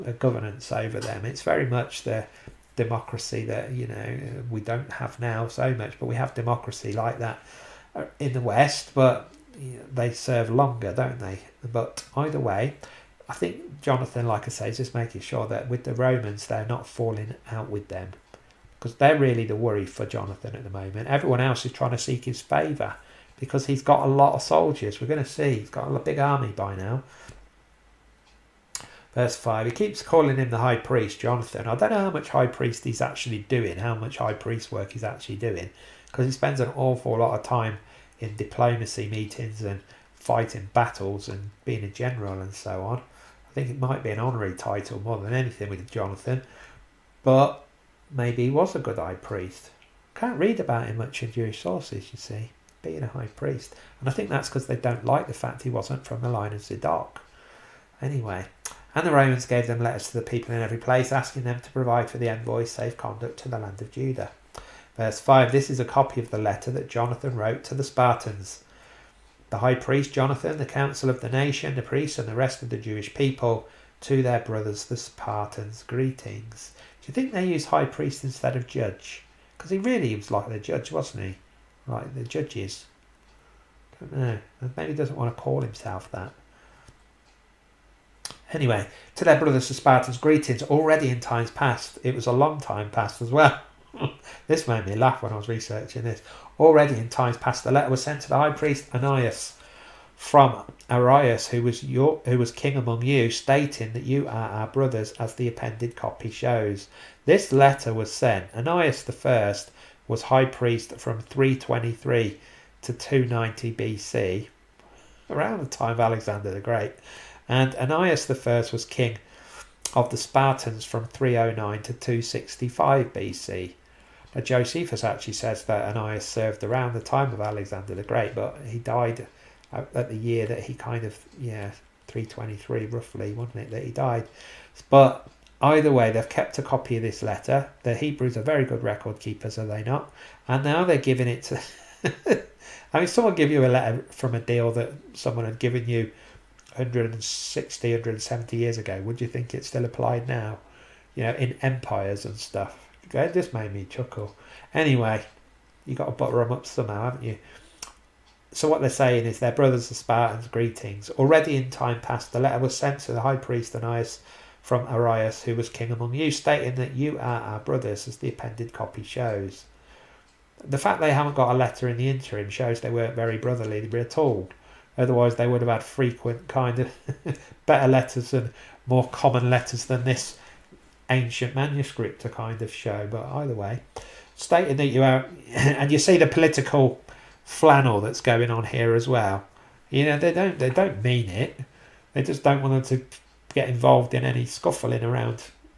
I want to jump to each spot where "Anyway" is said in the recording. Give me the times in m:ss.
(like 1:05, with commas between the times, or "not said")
0:57, 1:28, 2:34.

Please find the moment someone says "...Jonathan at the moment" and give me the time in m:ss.
0:20.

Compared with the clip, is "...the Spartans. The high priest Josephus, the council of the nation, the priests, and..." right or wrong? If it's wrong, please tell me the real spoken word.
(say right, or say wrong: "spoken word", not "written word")
wrong: "Jonathan", not "Josephus".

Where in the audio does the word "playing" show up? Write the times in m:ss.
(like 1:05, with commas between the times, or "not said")
not said.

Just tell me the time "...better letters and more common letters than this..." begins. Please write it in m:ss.
2:57.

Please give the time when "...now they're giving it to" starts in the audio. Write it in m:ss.
2:20.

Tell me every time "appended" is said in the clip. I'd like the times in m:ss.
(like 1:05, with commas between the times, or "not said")
1:45, 2:48.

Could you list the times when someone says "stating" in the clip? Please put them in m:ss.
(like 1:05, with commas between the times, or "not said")
1:43, 2:46, 3:04.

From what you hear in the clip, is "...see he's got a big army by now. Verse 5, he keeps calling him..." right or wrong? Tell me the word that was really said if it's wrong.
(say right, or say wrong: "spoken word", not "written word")
right.